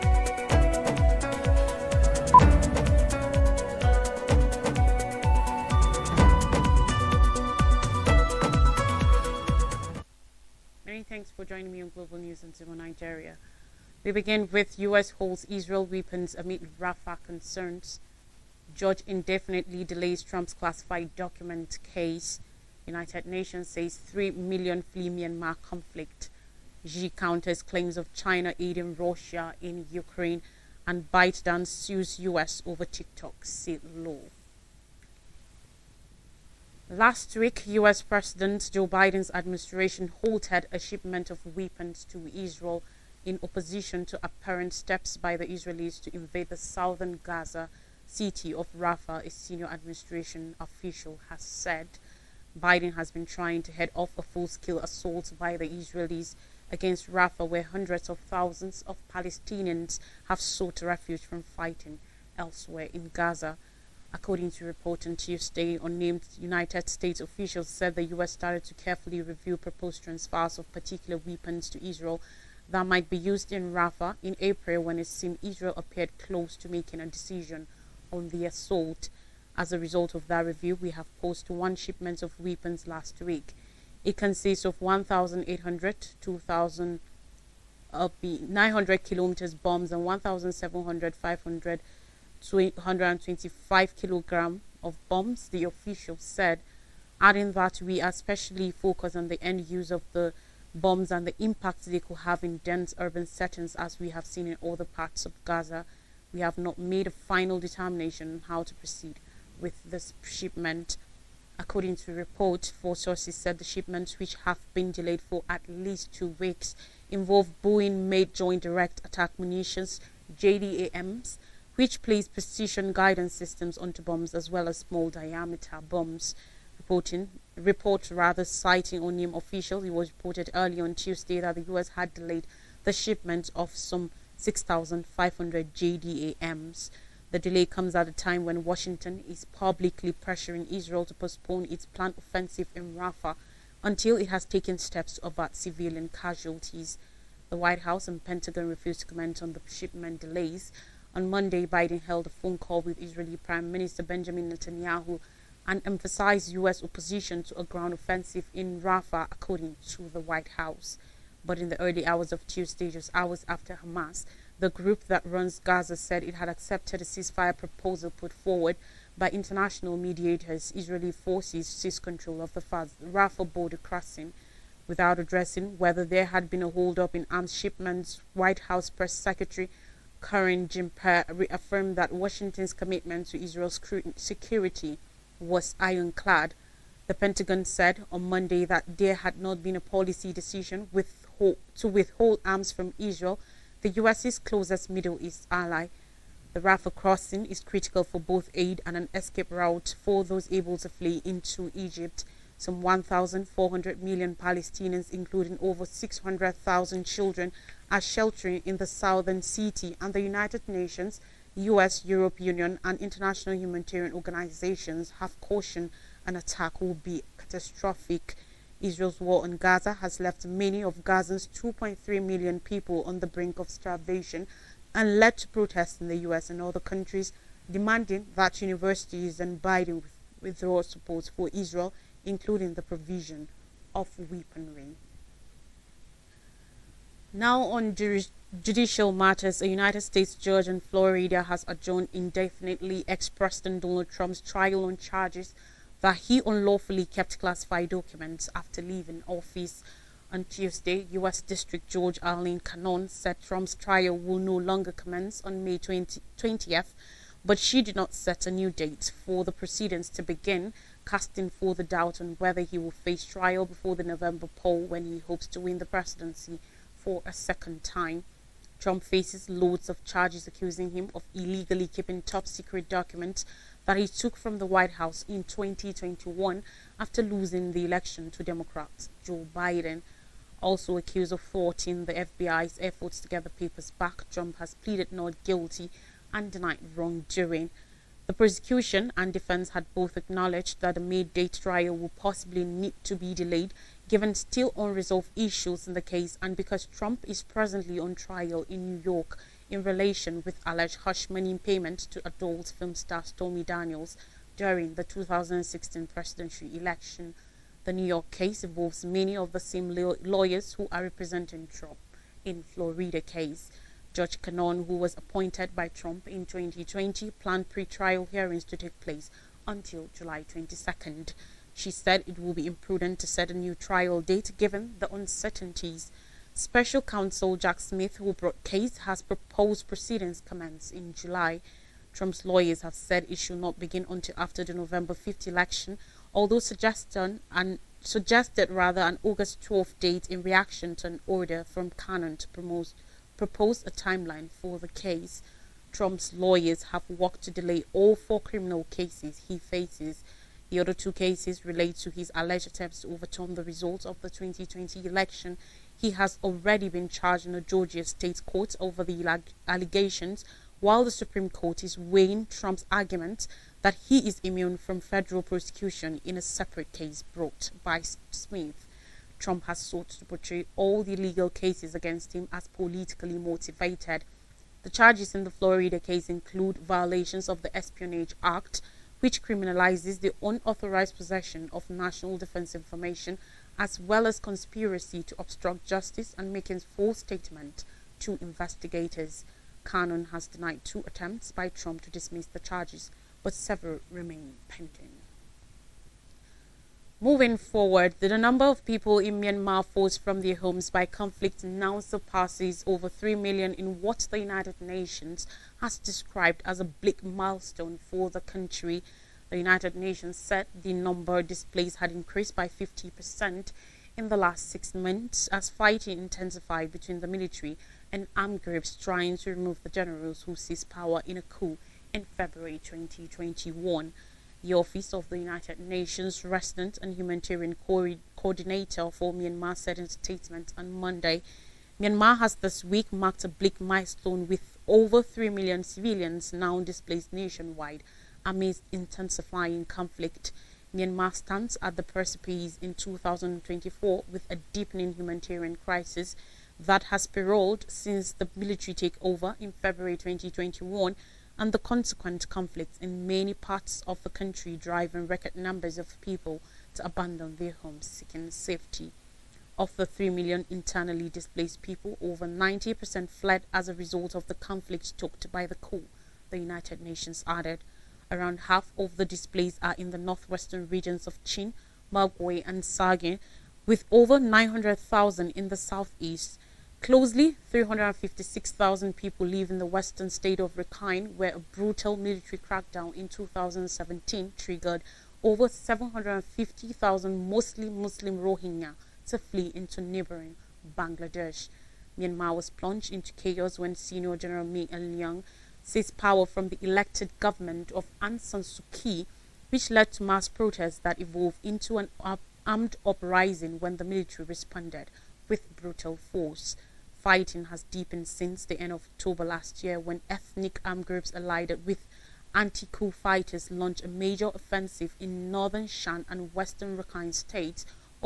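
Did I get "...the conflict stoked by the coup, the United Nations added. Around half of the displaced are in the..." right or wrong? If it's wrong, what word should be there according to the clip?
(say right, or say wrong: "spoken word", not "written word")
right.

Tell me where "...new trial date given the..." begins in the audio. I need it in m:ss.
5:23.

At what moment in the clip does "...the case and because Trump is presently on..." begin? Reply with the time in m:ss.
4:55.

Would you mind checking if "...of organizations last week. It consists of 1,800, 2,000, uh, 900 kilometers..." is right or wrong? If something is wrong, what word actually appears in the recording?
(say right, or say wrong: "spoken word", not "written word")
wrong: "weapons", not "organizations".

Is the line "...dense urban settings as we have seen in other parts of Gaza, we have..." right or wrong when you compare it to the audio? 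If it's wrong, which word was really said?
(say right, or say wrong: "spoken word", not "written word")
right.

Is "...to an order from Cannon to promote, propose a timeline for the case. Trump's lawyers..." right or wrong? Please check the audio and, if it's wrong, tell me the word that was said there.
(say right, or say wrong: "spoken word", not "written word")
right.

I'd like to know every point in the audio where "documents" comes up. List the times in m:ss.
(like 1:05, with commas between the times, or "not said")
0:21, 4:07, 4:32.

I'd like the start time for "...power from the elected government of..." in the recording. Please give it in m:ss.
8:16.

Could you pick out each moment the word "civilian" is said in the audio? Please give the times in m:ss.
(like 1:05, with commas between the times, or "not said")
2:25, 7:15.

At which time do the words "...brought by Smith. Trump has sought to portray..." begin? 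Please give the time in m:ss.
6:07.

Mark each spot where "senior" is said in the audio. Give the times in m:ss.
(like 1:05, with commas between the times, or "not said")
0:49, 8:13.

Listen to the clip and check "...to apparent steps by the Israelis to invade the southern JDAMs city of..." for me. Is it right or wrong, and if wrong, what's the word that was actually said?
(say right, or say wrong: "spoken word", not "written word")
wrong: "Gaza", not "JDAMs".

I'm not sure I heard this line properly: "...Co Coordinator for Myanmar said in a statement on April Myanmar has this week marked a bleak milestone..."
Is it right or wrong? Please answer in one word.
wrong.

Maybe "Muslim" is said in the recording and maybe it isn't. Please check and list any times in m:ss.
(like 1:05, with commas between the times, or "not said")
8:07.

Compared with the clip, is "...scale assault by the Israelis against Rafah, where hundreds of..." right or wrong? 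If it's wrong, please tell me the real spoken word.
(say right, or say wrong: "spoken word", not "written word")
right.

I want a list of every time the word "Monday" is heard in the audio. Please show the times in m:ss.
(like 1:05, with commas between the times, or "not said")
2:31, 3:08, 7:10.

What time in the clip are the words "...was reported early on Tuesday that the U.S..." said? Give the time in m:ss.
2:09.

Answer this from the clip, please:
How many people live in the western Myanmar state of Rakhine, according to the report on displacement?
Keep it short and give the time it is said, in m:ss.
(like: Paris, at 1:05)
356,000, at 7:57.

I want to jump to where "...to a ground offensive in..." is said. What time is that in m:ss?
2:37.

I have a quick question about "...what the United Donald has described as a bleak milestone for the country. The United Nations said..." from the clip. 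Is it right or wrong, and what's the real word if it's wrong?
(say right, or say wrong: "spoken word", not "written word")
wrong: "Nations", not "Donald".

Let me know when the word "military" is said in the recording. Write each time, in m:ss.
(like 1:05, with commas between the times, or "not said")
6:57, 7:28, 8:02, 8:24.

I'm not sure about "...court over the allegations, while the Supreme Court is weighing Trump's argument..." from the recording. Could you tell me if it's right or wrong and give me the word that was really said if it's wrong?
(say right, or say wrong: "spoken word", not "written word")
right.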